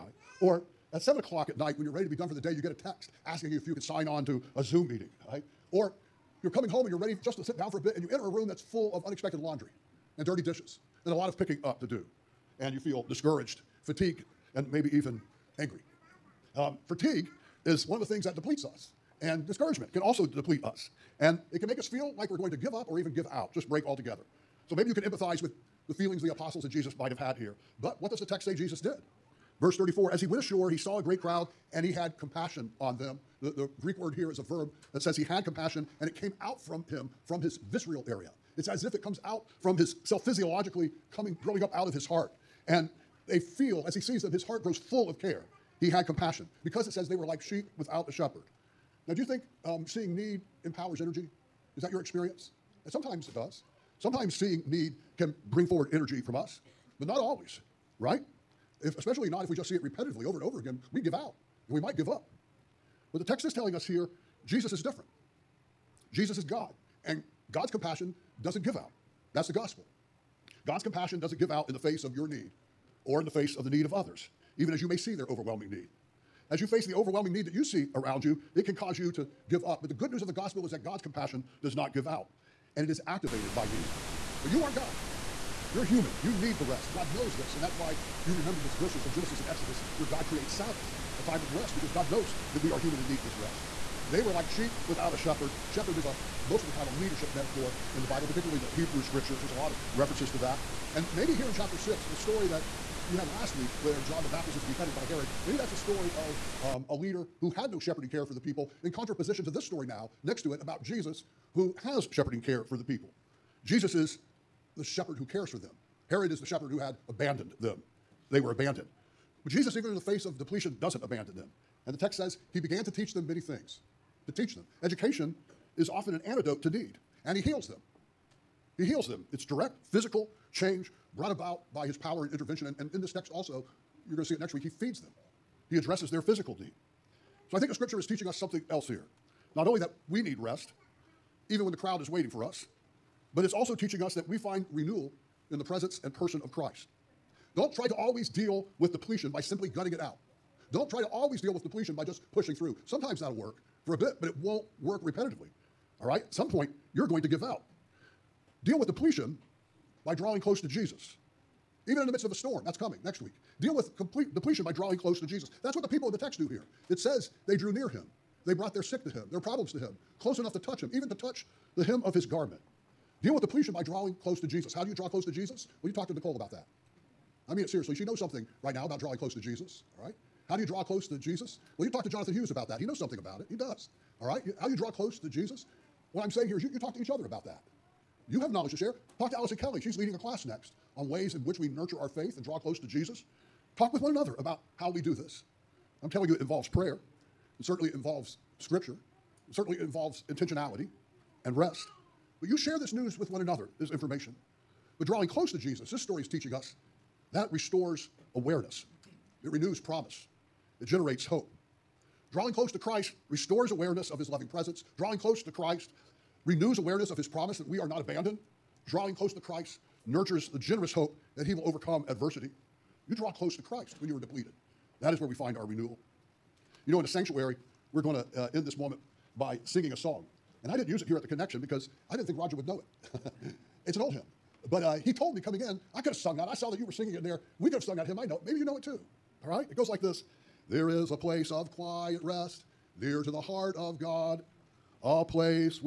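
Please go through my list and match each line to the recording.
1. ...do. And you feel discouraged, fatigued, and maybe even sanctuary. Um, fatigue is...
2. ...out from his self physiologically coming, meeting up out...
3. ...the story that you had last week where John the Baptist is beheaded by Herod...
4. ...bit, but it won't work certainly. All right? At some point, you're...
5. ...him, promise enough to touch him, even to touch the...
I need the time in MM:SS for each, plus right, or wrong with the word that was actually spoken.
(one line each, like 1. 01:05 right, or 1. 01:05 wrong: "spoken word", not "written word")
1. 00:11 wrong: "angry", not "sanctuary"
2. 00:39 wrong: "growing", not "meeting"
3. 01:42 right
4. 02:33 wrong: "repetitively", not "certainly"
5. 02:49 wrong: "close", not "promise".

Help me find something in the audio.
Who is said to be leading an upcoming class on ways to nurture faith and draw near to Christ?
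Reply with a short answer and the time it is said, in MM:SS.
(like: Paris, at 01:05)
Allison Kelly, at 03:09.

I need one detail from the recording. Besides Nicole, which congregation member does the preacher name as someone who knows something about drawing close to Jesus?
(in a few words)
Jonathan Hughes.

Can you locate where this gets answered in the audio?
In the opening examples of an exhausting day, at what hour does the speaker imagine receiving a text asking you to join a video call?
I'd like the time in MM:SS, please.
00:01.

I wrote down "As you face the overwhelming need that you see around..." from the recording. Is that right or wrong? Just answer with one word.
right.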